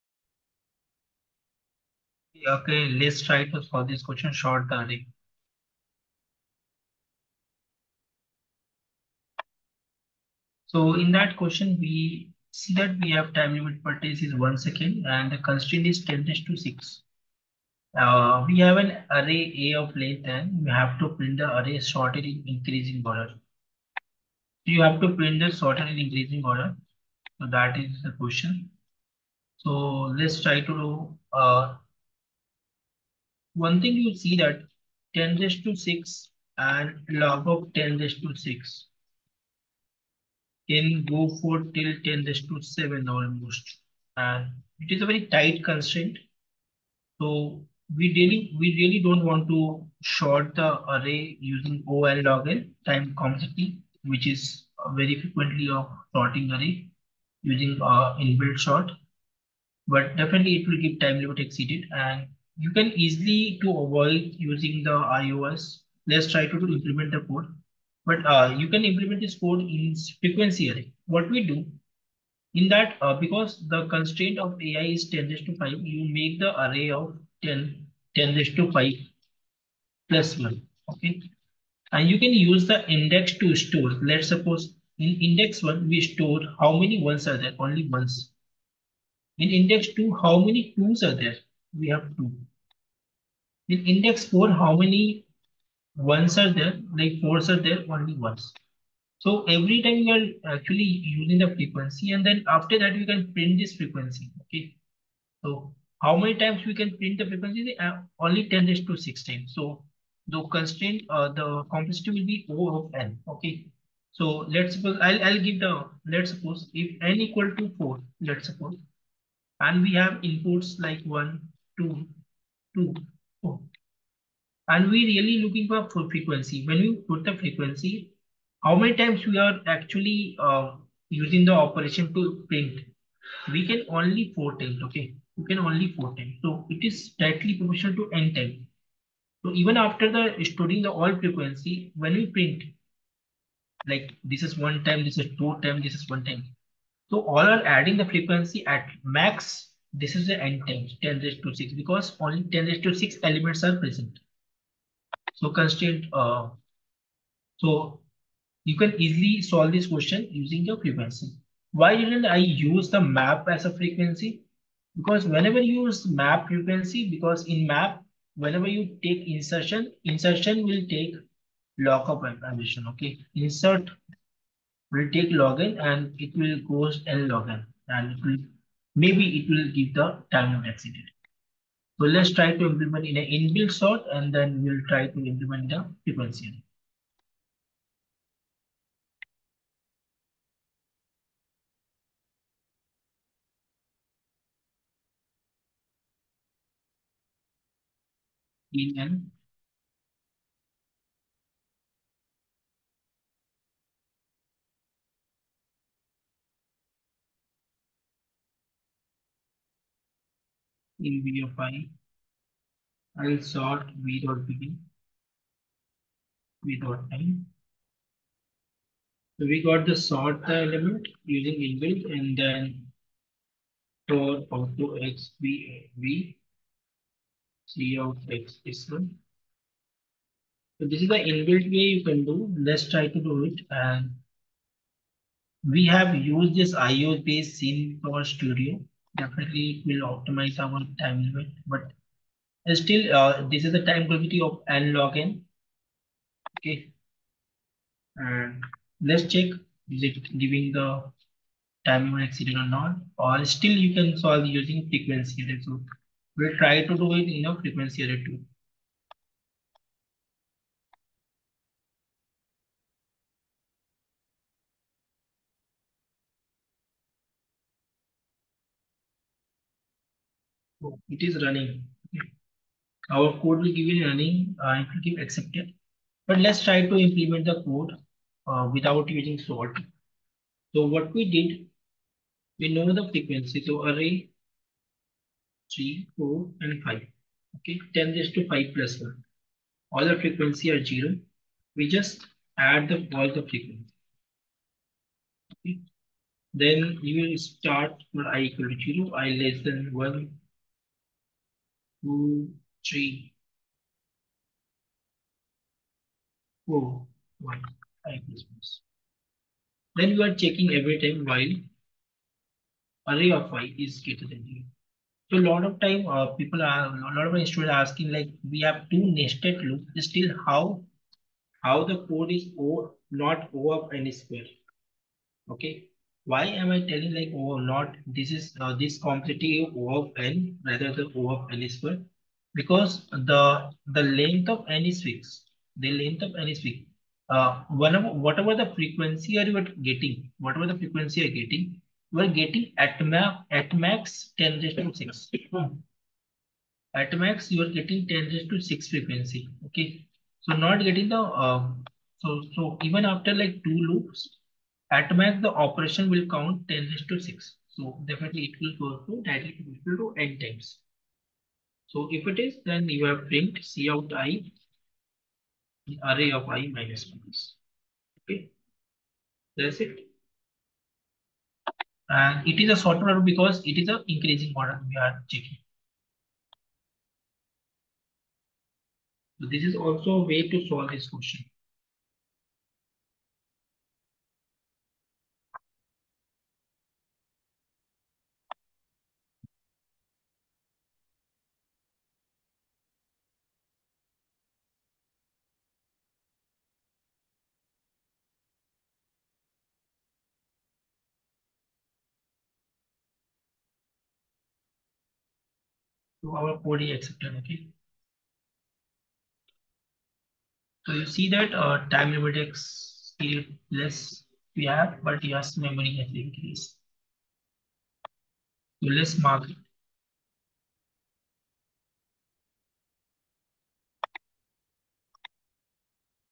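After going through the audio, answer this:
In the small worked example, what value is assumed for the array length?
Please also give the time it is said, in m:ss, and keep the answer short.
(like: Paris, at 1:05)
4, at 1:57.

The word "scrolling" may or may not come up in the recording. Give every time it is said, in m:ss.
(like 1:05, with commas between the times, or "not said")
not said.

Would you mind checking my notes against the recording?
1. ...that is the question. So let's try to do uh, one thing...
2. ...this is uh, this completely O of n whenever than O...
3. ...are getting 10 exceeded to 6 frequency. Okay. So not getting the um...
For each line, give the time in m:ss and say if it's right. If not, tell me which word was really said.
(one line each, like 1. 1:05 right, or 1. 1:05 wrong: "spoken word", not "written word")
1. 0:27 right
2. 5:28 wrong: "rather", not "whenever"
3. 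5:47 wrong: "raised", not "exceeded".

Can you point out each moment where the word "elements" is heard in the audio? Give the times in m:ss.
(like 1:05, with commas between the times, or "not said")
2:33, 3:40.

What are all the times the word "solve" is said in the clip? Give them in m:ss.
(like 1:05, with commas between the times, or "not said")
0:03, 2:39, 4:14, 6:20.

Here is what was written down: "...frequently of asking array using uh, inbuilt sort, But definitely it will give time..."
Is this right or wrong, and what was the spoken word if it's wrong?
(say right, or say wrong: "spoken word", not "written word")
wrong: "sorting", not "asking".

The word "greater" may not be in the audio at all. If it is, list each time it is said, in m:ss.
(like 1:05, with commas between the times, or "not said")
5:14.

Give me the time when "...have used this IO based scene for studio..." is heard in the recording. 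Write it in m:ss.
3:55.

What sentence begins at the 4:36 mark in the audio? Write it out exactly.
But let's try to implement the code uh, without using sort.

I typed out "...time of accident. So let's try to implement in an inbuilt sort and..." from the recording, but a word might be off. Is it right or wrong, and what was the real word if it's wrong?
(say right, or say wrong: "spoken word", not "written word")
right.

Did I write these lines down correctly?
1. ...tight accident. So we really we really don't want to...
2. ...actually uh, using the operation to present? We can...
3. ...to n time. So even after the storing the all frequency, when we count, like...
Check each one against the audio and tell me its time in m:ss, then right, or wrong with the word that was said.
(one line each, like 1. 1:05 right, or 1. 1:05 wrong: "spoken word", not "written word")
1. 0:45 wrong: "constraint", not "accident"
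2. 2:09 wrong: "print", not "present"
3. 2:17 wrong: "print", not "count".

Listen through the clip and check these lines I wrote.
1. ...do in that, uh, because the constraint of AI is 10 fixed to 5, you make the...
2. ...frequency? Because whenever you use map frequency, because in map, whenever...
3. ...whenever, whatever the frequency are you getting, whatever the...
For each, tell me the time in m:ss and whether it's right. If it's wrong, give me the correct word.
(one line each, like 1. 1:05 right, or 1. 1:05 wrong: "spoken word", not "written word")
1. 1:11 wrong: "raised", not "fixed"
2. 2:43 right
3. 5:37 right.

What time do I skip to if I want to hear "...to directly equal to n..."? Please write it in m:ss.
5:59.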